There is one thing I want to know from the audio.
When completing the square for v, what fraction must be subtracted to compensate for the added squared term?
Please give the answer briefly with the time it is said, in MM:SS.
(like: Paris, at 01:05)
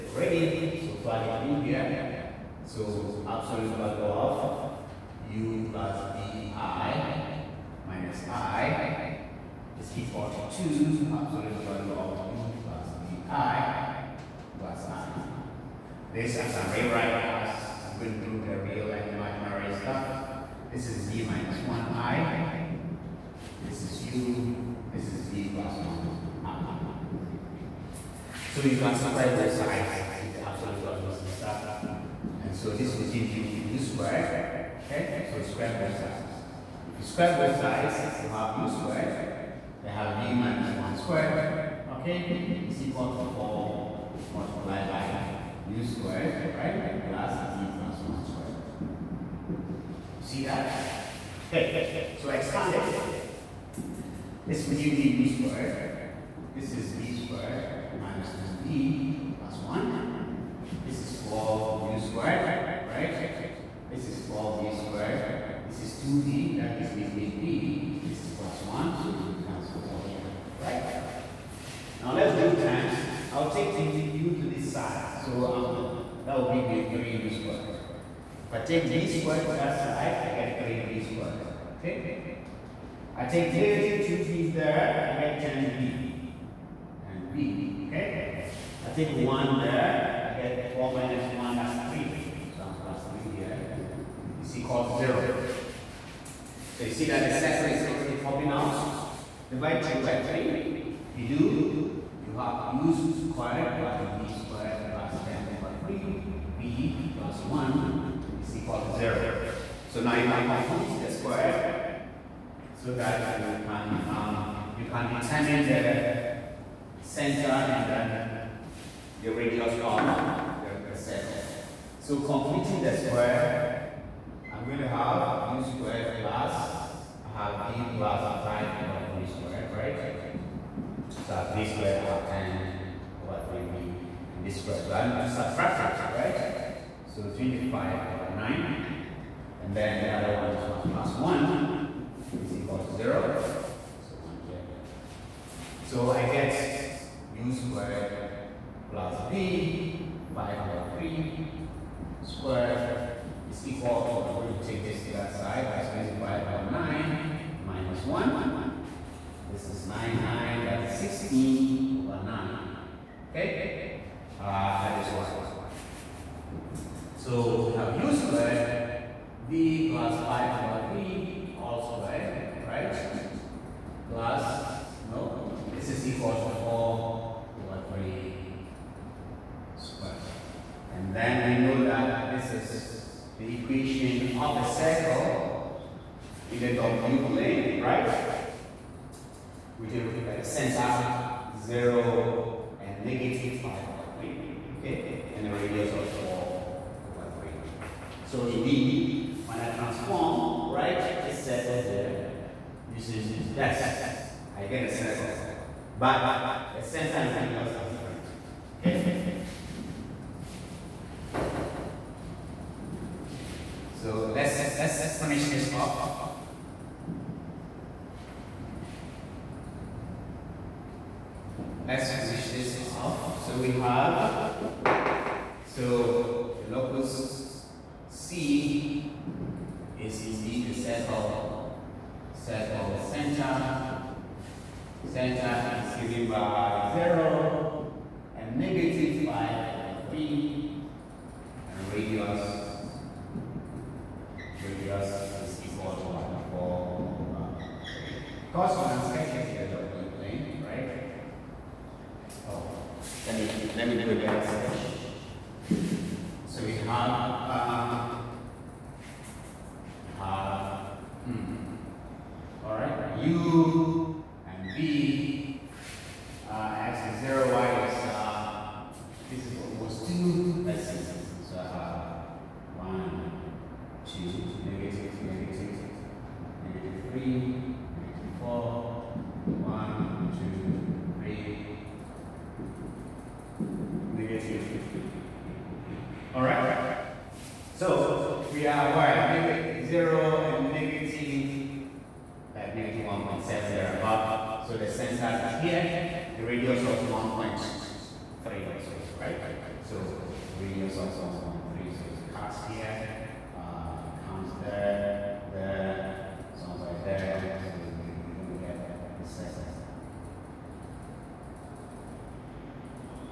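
25/9, at 02:17.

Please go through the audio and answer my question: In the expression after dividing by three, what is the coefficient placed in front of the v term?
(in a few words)
10/3.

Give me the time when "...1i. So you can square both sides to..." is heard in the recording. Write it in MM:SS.
00:26.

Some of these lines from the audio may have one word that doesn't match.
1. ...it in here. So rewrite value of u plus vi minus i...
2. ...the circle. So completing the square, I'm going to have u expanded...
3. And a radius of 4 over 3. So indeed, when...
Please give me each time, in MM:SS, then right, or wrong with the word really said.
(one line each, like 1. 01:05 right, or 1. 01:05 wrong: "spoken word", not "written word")
1. 00:01 wrong: "absolute", not "rewrite"
2. 02:00 wrong: "squared", not "expanded"
3. 03:15 right.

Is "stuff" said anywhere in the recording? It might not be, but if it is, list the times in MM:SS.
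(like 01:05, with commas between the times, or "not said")
00:19, 00:31.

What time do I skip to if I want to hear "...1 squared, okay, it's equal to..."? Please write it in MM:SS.
00:40.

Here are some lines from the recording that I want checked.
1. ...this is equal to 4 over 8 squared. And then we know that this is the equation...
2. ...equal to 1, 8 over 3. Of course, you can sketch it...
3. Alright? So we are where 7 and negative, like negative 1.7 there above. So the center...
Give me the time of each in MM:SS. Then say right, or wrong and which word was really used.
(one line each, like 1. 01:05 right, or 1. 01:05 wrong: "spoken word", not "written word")
1. 02:55 wrong: "3", not "8"
2. 04:05 wrong: "4", not "8"
3. 04:46 wrong: "0", not "7".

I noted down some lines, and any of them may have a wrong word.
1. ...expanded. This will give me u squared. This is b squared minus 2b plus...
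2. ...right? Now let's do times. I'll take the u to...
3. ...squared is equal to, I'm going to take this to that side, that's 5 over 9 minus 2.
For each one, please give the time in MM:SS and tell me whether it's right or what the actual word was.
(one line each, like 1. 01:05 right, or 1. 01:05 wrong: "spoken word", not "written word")
1. 00:52 right
2. 01:10 right
3. 02:32 wrong: "1", not "2".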